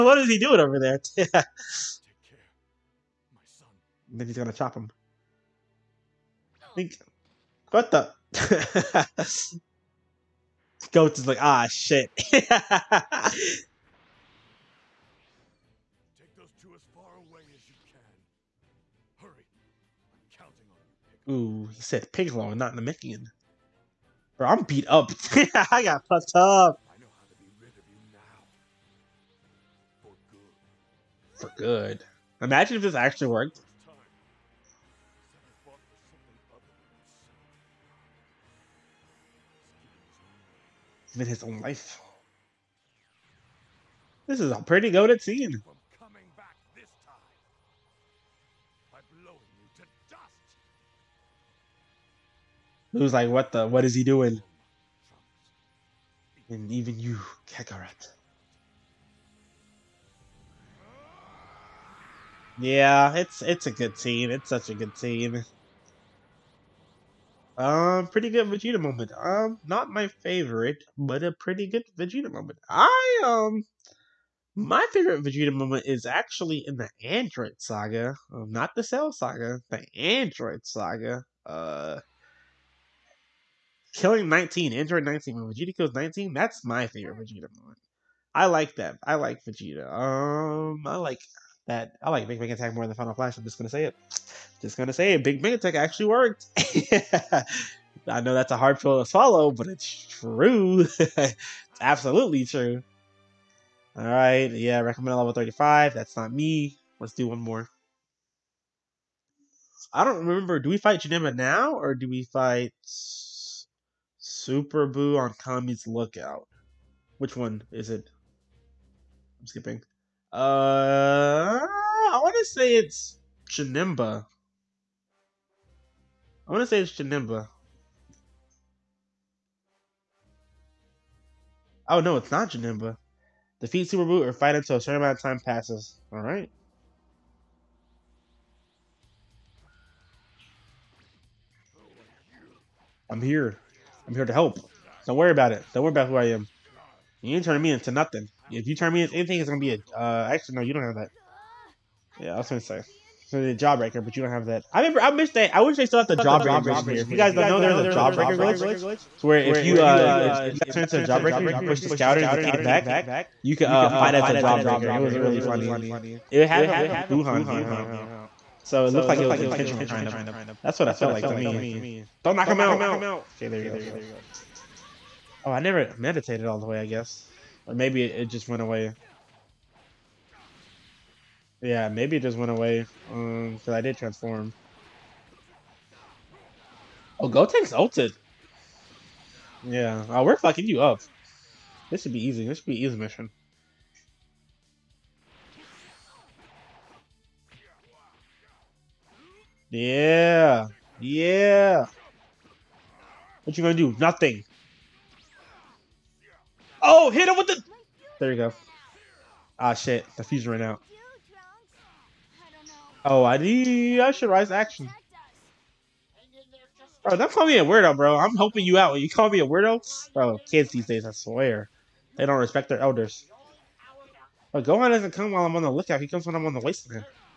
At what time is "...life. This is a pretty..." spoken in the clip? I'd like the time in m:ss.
0:41.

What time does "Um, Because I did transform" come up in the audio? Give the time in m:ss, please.
3:03.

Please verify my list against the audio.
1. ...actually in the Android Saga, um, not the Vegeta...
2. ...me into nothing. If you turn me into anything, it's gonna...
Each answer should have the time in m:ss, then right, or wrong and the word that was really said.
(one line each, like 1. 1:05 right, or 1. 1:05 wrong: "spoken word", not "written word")
1. 1:16 wrong: "Cell", not "Vegeta"
2. 2:27 right.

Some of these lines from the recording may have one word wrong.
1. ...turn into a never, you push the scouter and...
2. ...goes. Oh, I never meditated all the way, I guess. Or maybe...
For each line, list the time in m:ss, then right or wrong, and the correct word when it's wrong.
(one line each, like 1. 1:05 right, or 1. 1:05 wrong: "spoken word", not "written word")
1. 2:40 wrong: "jawbreaker", not "never"
2. 2:53 right.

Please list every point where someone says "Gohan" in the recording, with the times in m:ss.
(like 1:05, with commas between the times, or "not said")
3:44.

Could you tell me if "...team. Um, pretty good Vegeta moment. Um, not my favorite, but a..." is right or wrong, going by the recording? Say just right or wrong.
right.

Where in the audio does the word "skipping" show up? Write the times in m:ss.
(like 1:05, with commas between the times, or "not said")
1:59.